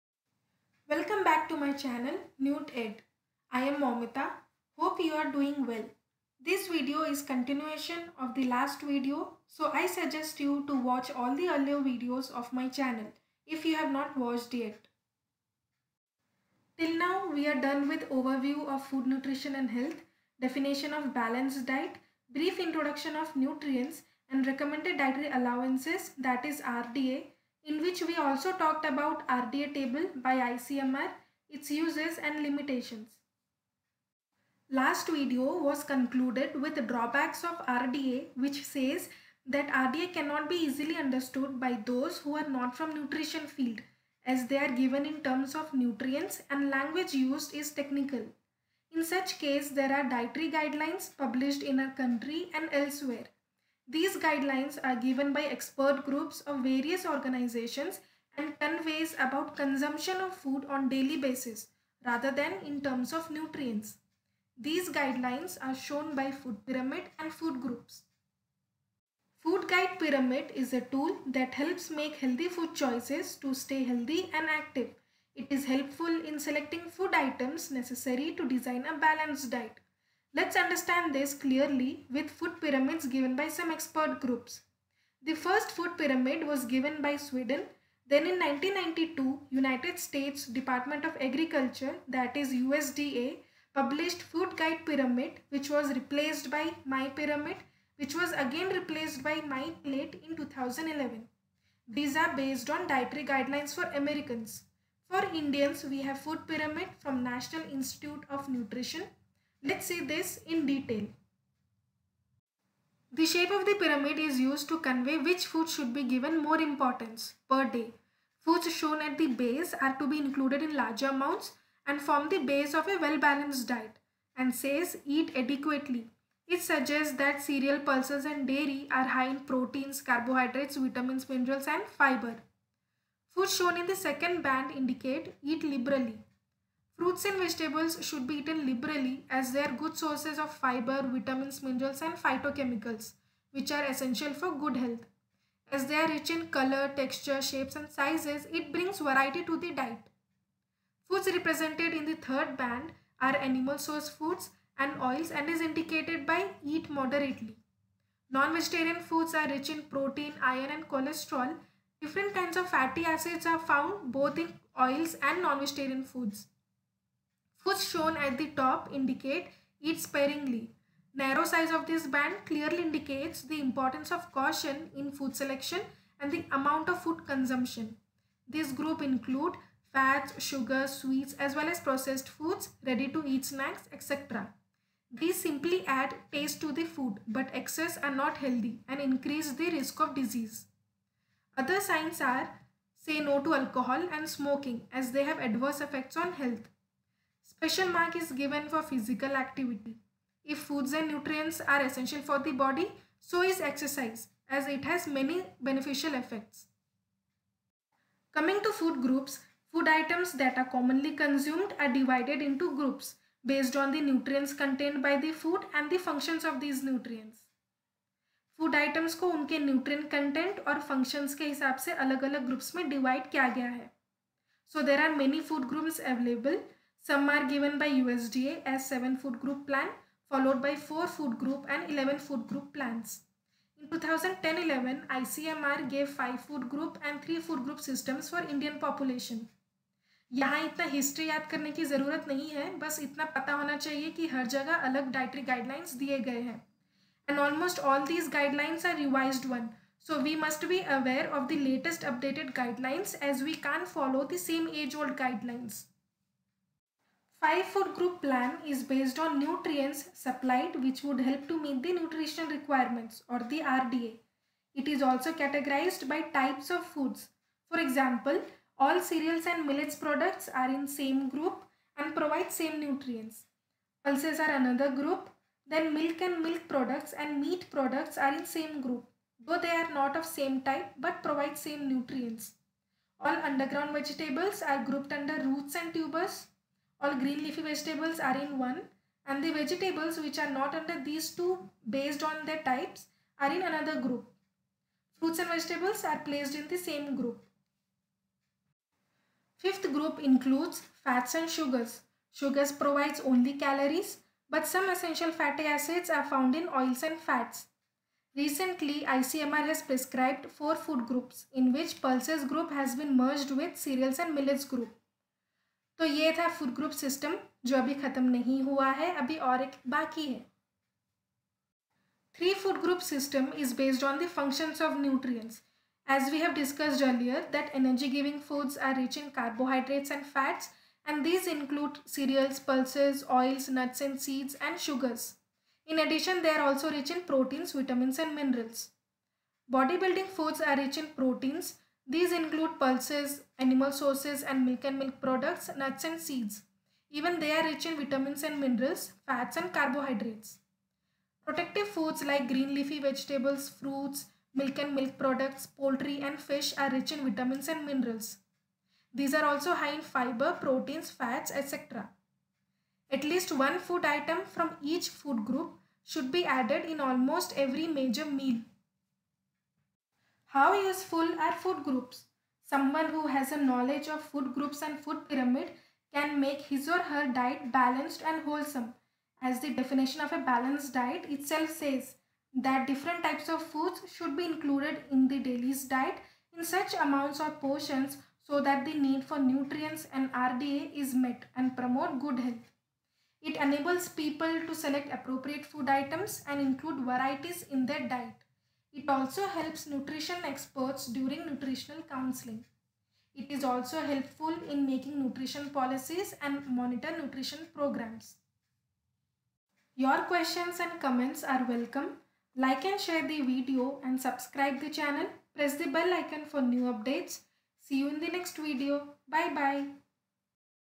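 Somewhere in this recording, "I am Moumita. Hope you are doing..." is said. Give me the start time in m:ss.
0:03.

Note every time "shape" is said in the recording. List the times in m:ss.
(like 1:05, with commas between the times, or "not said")
1:53, 2:27.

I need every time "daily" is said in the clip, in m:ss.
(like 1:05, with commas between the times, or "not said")
1:00, 6:25.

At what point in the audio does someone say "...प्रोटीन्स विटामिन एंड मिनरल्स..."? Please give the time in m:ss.
5:37.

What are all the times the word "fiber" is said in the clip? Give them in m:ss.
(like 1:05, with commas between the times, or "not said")
2:11, 2:20, 6:00.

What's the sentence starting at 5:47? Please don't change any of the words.
Even they are rich in vitamins and minerals, fats and carbohydrates.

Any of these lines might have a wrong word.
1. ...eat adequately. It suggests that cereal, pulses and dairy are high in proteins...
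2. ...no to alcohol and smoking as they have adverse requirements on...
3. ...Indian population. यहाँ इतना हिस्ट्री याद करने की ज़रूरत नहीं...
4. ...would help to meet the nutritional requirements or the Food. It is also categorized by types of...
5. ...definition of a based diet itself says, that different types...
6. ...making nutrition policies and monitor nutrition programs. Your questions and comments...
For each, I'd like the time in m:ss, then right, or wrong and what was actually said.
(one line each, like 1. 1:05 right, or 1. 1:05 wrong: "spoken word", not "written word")
1. 2:05 right
2. 3:13 wrong: "effects", not "requirements"
3. 3:58 right
4. 4:21 wrong: "RDA", not "Food"
5. 6:19 wrong: "balanced", not "based"
6. 6:44 right.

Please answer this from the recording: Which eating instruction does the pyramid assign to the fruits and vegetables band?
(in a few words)
Eat liberally.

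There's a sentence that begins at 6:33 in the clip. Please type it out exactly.
It enables people to select appropriate food items and include varieties in their diet.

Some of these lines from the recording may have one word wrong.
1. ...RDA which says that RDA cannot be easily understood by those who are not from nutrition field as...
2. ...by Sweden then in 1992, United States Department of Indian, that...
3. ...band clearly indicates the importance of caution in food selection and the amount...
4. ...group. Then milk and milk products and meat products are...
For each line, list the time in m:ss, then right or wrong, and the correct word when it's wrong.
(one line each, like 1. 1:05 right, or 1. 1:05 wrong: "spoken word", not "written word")
1. 0:37 right
2. 1:27 wrong: "Agriculture", not "Indian"
3. 2:52 right
4. 4:34 right.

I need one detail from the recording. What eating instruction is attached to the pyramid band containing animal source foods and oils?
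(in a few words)
Eat moderately.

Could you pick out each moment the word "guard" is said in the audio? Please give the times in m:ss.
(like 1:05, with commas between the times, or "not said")
not said.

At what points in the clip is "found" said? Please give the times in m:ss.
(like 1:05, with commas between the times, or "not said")
2:43, 5:06.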